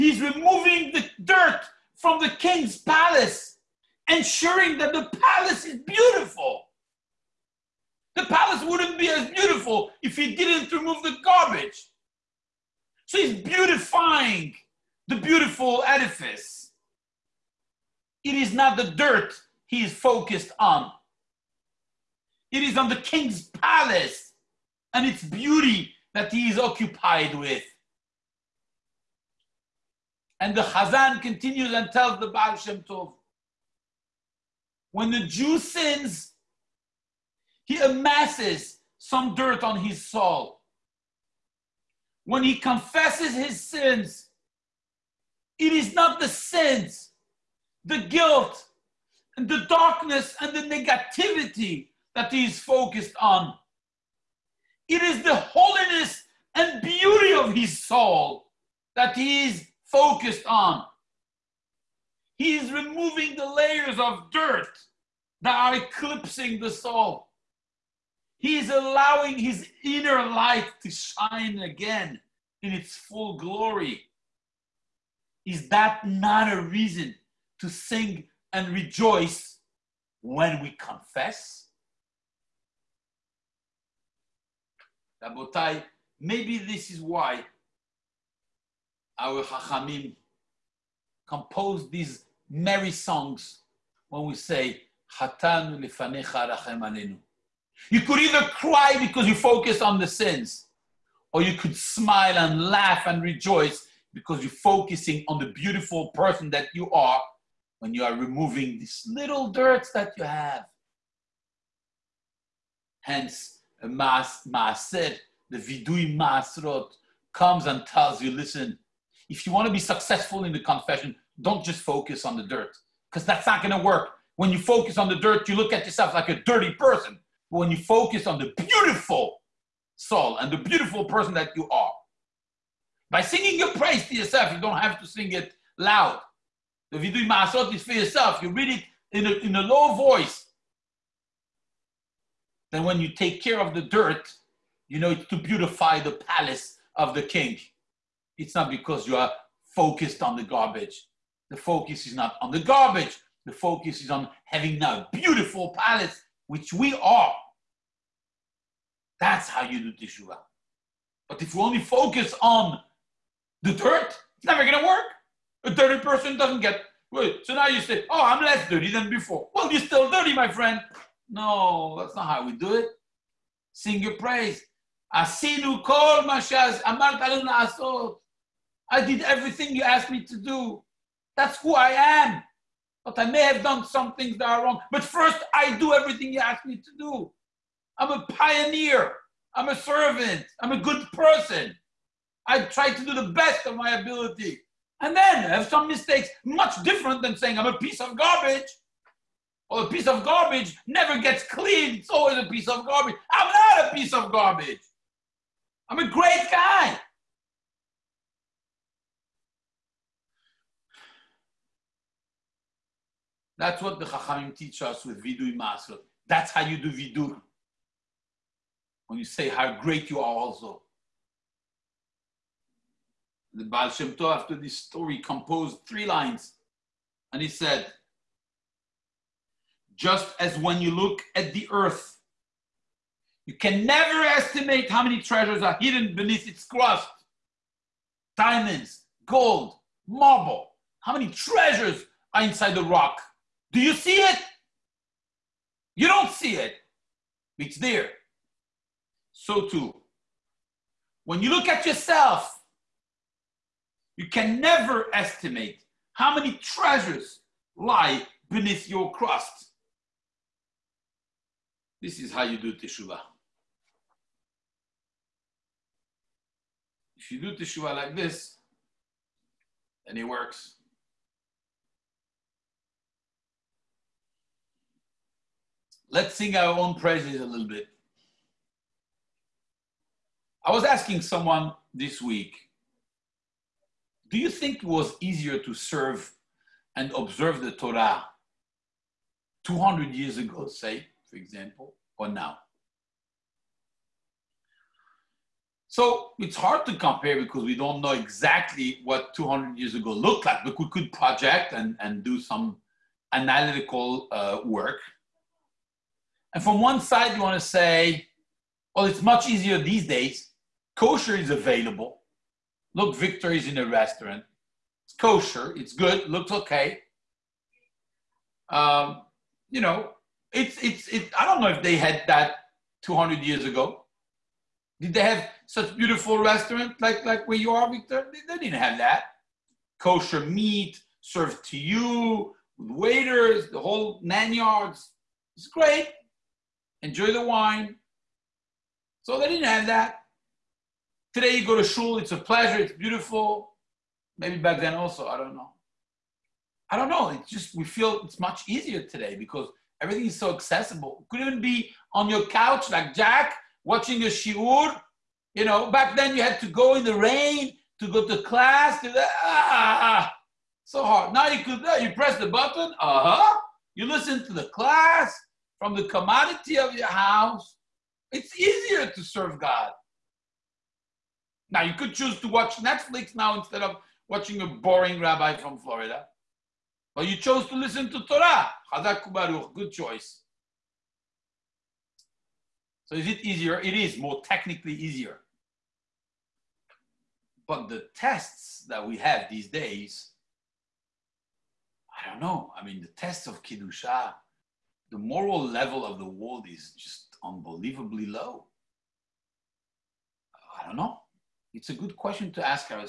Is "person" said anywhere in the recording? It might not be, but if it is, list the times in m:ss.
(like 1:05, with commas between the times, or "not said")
1:46, 2:06, 2:11, 2:46, 3:11.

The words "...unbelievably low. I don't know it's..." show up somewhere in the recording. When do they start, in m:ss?
6:37.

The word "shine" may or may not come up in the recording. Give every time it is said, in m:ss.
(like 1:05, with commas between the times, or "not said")
1:10.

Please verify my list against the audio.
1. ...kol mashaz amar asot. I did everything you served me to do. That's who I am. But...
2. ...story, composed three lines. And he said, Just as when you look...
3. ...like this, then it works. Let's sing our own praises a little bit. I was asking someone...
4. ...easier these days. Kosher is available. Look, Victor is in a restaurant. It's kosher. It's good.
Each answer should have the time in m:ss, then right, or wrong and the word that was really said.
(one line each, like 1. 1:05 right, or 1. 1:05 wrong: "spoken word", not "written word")
1. 2:55 wrong: "asked", not "served"
2. 3:44 right
3. 4:27 right
4. 5:09 right.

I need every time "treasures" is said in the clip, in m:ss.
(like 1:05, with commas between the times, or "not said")
3:55, 4:01, 4:16.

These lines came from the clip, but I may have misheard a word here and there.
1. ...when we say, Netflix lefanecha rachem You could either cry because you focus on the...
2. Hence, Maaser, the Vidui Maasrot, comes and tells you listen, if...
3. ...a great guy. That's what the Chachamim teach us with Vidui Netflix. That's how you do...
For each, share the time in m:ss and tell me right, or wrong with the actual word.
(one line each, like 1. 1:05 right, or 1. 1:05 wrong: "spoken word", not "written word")
1. 1:34 wrong: "Hatanu", not "Netflix"
2. 1:53 right
3. 3:25 wrong: "Maasrot", not "Netflix".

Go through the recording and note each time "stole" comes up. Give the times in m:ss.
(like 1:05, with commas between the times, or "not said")
not said.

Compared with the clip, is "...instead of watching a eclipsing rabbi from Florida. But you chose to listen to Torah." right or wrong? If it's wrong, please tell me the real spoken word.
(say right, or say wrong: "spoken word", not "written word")
wrong: "boring", not "eclipsing".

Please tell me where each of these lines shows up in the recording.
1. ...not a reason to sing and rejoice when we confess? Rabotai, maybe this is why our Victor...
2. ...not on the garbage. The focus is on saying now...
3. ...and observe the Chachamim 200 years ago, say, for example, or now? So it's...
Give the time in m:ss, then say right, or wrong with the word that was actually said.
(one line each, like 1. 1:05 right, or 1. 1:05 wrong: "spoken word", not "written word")
1. 1:16 wrong: "Chachamim", not "Victor"
2. 2:32 wrong: "having", not "saying"
3. 4:46 wrong: "Torah", not "Chachamim".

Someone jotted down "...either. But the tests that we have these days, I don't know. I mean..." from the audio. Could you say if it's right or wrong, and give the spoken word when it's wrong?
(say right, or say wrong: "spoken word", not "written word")
wrong: "easier", not "either".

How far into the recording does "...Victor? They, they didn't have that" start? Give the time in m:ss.
5:27.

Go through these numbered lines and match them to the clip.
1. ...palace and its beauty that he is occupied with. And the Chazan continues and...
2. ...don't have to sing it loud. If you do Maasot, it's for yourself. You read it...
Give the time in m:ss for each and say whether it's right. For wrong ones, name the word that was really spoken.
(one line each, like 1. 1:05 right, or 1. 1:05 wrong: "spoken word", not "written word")
1. 0:23 right
2. 2:14 right.